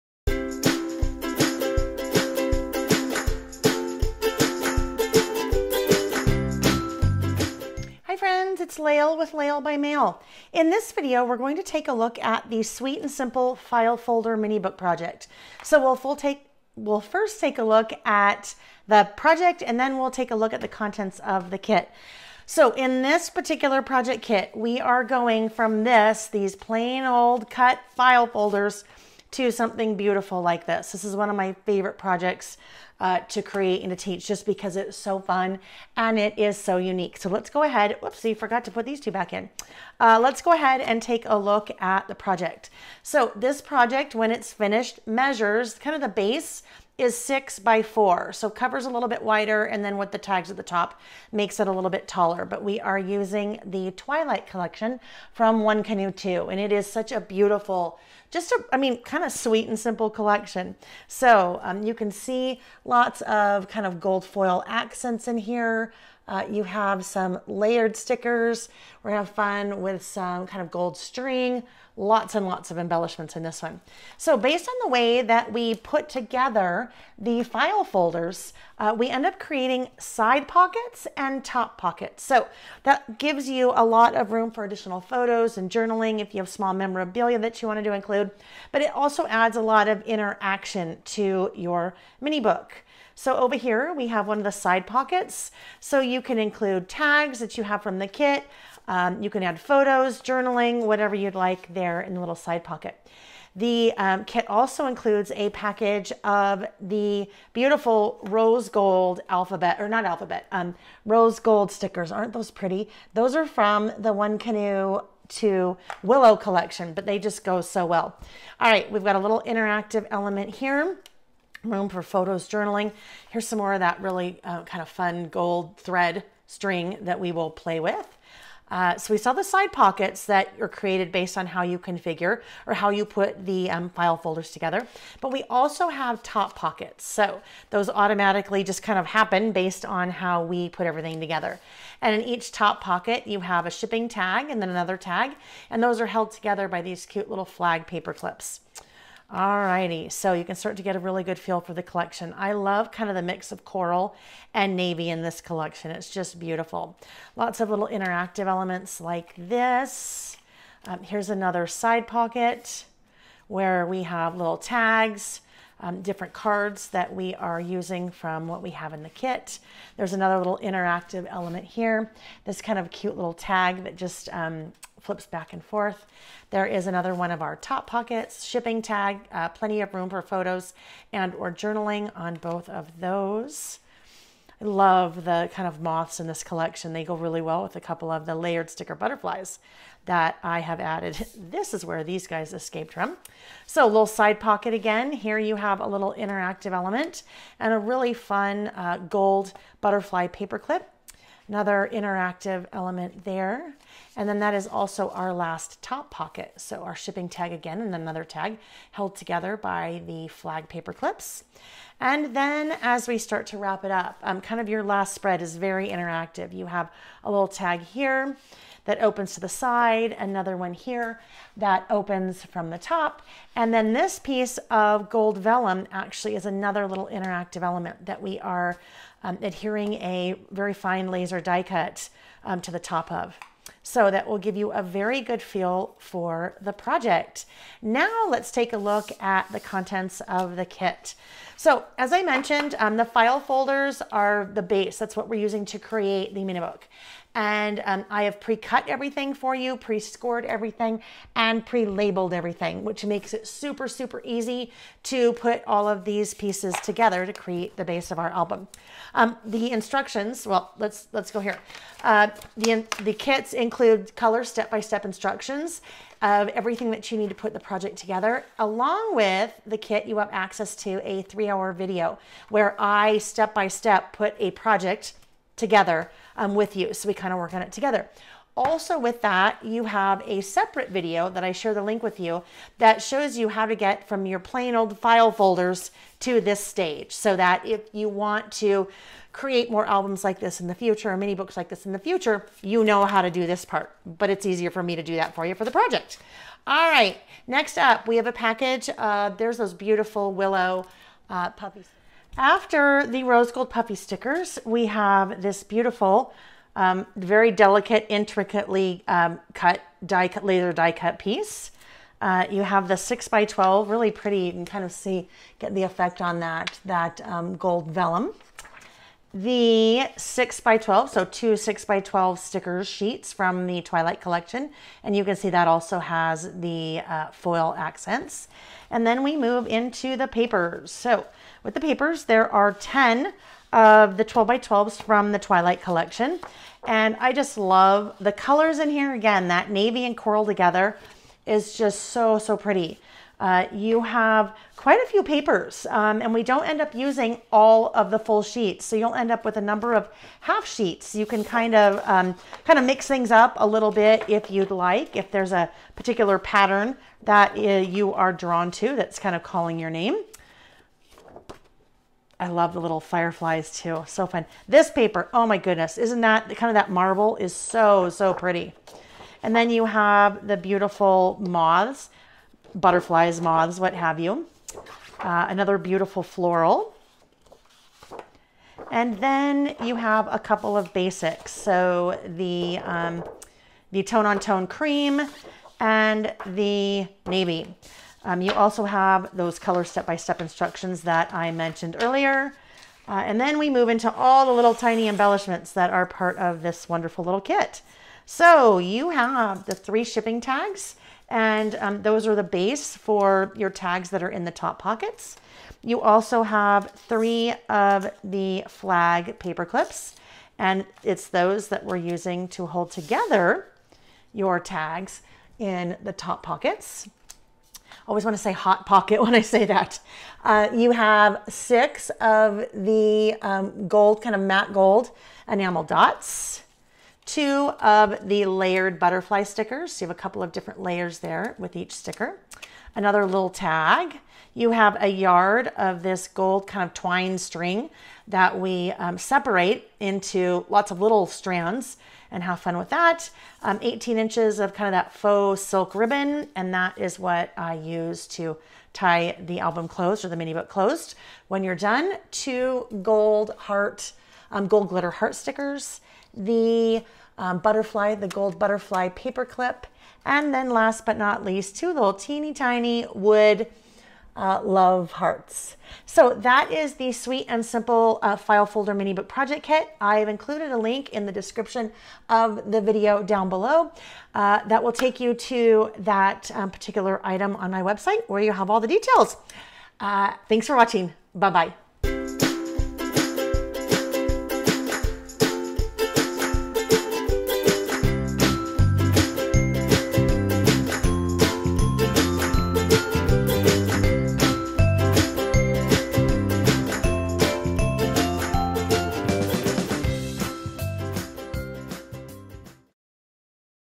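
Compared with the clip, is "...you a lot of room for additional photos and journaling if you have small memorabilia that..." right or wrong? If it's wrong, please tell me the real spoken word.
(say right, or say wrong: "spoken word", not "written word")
right.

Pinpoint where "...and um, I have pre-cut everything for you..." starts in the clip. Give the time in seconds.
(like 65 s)
247 s.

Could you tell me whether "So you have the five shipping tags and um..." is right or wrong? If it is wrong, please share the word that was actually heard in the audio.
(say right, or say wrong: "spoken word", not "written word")
wrong: "three", not "five".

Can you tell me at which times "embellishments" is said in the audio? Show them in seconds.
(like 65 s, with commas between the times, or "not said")
72 s, 395 s.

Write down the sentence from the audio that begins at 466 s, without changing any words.
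So that is the Sweet and Simple uh, File Folder Mini Book Project Kit.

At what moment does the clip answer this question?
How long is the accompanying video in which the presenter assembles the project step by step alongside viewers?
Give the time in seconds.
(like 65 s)
271 s.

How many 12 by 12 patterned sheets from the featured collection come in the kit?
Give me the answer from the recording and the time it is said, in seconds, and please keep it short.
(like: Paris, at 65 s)
10, at 332 s.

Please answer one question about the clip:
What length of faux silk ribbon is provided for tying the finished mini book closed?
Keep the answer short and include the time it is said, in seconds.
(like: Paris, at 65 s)
18 inches, at 443 s.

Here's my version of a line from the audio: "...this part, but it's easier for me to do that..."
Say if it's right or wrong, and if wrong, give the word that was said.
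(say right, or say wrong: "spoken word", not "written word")
right.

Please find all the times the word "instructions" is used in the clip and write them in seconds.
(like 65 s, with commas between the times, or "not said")
259 s, 265 s, 390 s.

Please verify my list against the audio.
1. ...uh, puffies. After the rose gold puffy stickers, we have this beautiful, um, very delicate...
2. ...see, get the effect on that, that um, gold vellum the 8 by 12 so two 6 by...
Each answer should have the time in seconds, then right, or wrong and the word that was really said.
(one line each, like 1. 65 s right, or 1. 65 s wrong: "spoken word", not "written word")
1. 301 s right
2. 314 s wrong: "6", not "8".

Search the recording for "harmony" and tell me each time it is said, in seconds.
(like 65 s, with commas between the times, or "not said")
not said.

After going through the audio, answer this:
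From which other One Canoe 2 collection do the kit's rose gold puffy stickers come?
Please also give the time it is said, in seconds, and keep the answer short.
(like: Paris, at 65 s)
Willow Collection, at 116 s.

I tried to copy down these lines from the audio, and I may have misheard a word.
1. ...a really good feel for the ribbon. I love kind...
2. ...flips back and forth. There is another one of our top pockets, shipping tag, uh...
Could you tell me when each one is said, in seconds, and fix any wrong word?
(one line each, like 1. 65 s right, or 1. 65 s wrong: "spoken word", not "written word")
1. 150 s wrong: "collection", not "ribbon"
2. 175 s right.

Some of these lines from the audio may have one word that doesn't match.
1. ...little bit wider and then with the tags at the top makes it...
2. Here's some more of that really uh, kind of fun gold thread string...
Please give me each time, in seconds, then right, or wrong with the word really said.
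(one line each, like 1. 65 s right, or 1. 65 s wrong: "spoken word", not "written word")
1. 48 s right
2. 123 s right.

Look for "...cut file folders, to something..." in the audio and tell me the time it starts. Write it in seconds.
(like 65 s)
27 s.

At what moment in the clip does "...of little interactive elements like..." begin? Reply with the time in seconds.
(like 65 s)
157 s.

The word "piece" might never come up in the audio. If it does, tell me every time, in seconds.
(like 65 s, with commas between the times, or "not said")
224 s, 256 s, 311 s.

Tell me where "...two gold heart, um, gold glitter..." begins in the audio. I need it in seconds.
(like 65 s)
452 s.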